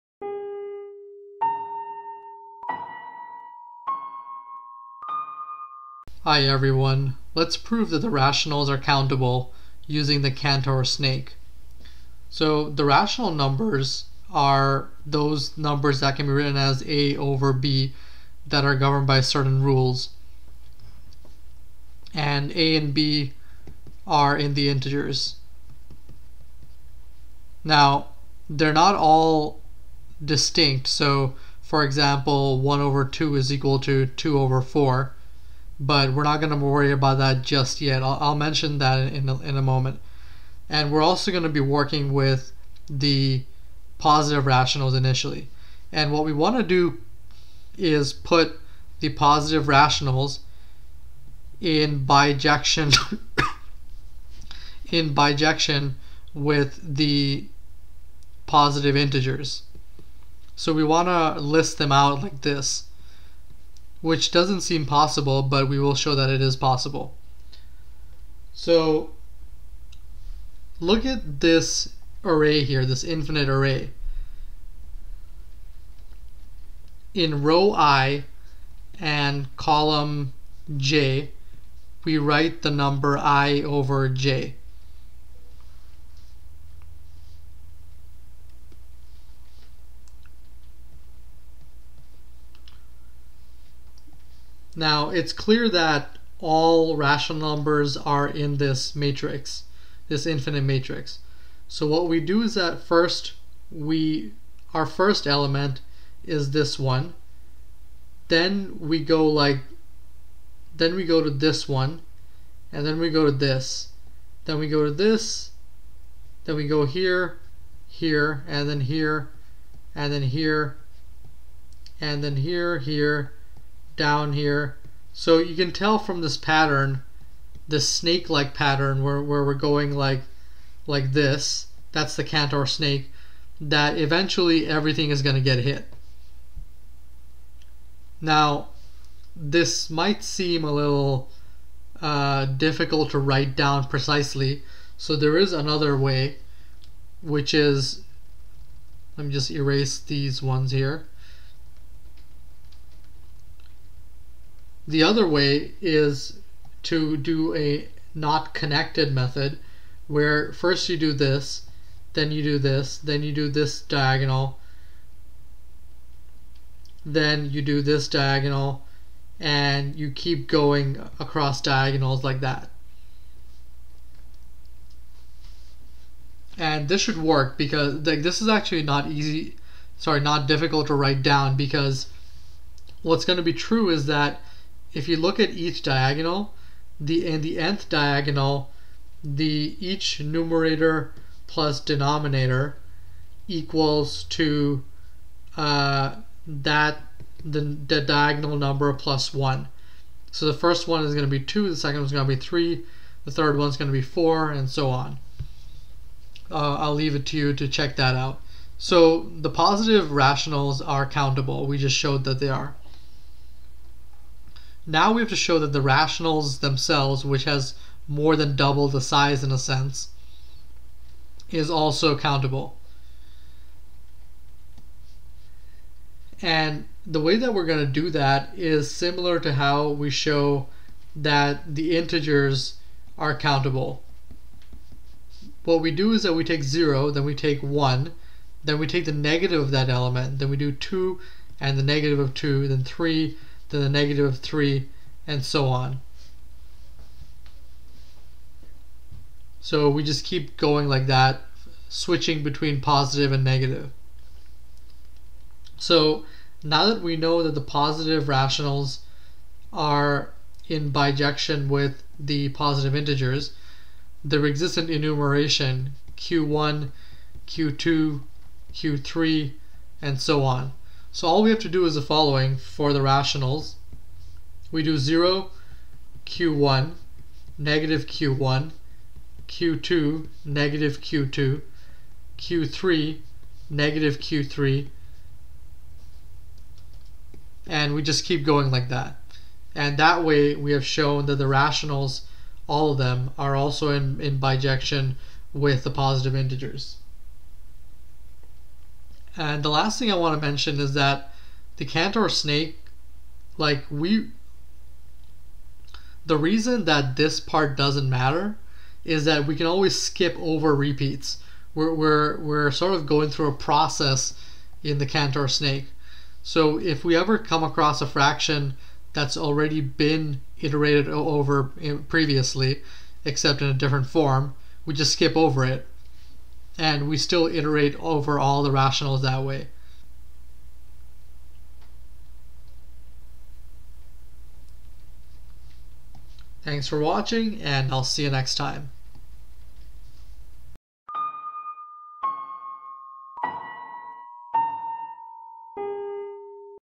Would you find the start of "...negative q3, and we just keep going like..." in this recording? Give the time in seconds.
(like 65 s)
283 s.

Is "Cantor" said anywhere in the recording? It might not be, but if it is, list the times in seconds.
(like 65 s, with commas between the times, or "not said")
10 s, 132 s, 301 s, 315 s.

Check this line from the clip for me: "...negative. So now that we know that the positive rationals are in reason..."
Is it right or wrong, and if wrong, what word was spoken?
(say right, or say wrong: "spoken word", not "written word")
wrong: "bijection", not "reason".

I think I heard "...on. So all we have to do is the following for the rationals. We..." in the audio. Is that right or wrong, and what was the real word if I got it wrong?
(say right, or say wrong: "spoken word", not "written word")
right.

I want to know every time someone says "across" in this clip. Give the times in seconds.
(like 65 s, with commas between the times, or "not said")
171 s, 317 s.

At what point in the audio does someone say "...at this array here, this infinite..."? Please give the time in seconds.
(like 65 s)
71 s.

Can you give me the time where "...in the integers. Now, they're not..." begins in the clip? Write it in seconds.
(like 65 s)
24 s.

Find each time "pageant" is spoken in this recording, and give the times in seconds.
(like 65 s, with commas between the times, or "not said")
not said.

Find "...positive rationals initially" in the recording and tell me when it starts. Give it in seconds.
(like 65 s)
43 s.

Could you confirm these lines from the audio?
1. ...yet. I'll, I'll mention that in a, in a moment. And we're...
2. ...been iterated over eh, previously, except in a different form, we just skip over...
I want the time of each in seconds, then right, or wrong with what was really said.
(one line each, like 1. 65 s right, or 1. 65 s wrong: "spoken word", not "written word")
1. 37 s right
2. 319 s right.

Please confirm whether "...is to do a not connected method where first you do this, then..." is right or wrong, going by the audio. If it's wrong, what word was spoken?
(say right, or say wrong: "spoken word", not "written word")
right.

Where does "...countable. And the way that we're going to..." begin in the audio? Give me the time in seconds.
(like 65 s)
222 s.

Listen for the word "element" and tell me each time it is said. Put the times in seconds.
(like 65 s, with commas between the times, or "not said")
105 s, 239 s.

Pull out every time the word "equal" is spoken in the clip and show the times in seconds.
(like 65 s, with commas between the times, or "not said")
33 s, 193 s.